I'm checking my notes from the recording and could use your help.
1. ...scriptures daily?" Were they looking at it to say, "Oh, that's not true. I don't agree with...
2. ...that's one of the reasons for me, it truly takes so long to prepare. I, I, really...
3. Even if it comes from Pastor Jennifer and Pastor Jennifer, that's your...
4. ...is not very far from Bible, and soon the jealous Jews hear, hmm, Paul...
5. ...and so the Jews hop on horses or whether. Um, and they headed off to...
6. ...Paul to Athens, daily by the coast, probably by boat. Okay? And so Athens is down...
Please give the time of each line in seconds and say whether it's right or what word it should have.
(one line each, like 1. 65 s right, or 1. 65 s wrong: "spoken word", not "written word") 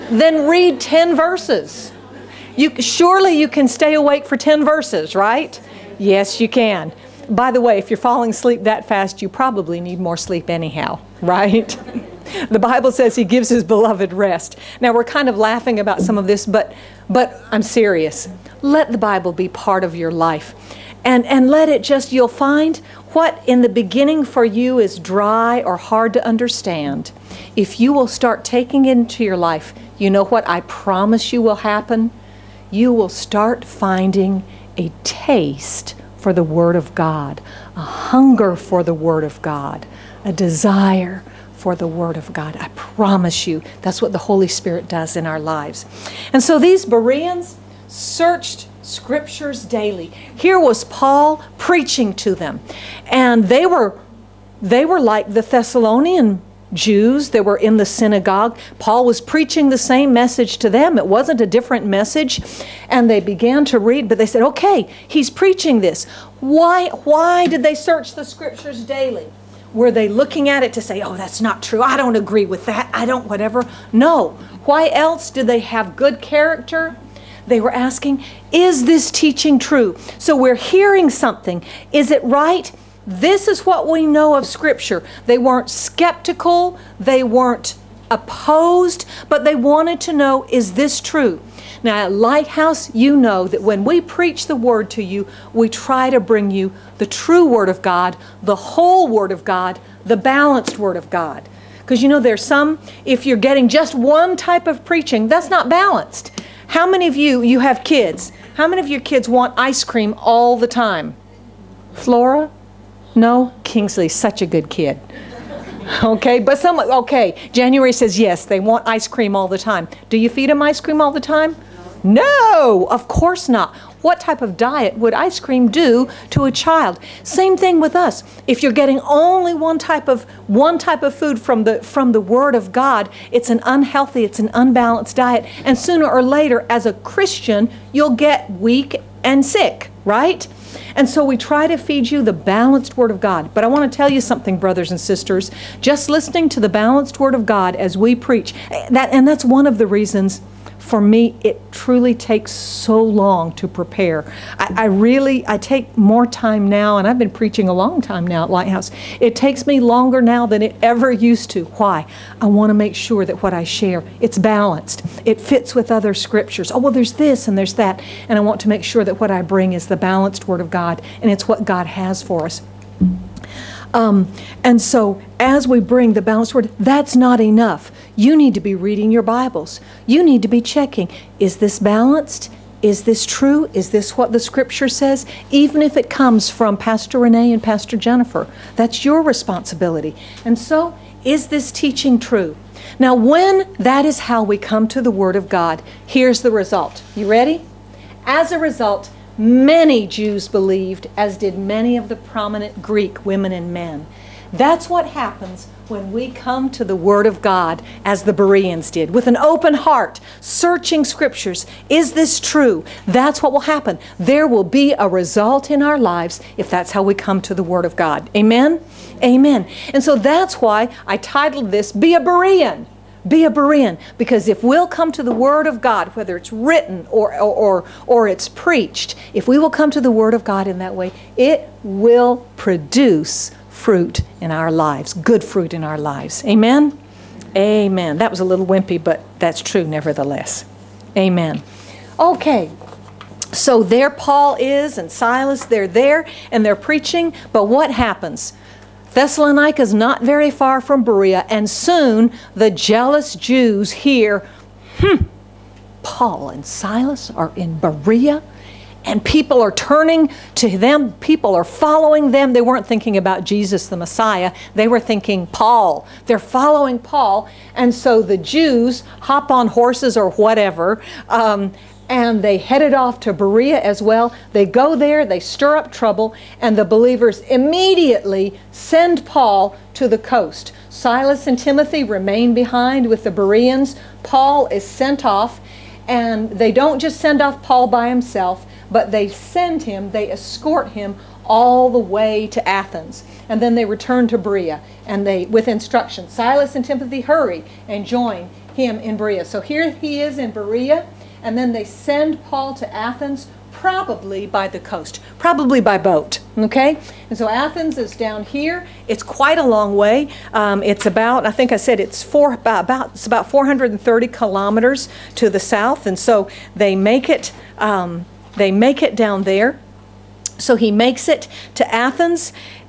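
1. 68 s right
2. 149 s right
3. 185 s wrong: "Renee", not "Jennifer"
4. 249 s wrong: "Berea", not "Bible"
5. 267 s wrong: "whatever", not "whether"
6. 302 s wrong: "probably", not "daily".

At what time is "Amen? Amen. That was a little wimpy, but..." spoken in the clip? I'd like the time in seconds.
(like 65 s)
236 s.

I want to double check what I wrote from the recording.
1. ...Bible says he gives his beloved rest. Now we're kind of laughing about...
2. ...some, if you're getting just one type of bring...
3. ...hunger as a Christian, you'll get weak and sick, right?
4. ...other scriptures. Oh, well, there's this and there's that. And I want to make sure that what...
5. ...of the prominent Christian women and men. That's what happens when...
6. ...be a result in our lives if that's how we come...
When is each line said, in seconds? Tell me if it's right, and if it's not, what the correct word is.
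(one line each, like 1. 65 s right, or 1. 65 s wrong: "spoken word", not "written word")
1. 12 s right
2. 102 s wrong: "preaching", not "bring"
3. 136 s wrong: "later", not "hunger"
4. 165 s right
5. 201 s wrong: "Greek", not "Christian"
6. 214 s right.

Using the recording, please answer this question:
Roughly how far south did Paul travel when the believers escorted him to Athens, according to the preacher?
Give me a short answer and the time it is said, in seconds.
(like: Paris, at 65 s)
430 kilometers, at 313 s.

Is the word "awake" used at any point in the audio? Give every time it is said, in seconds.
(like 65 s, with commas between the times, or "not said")
3 s.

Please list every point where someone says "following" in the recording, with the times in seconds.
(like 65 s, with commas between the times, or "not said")
261 s, 266 s.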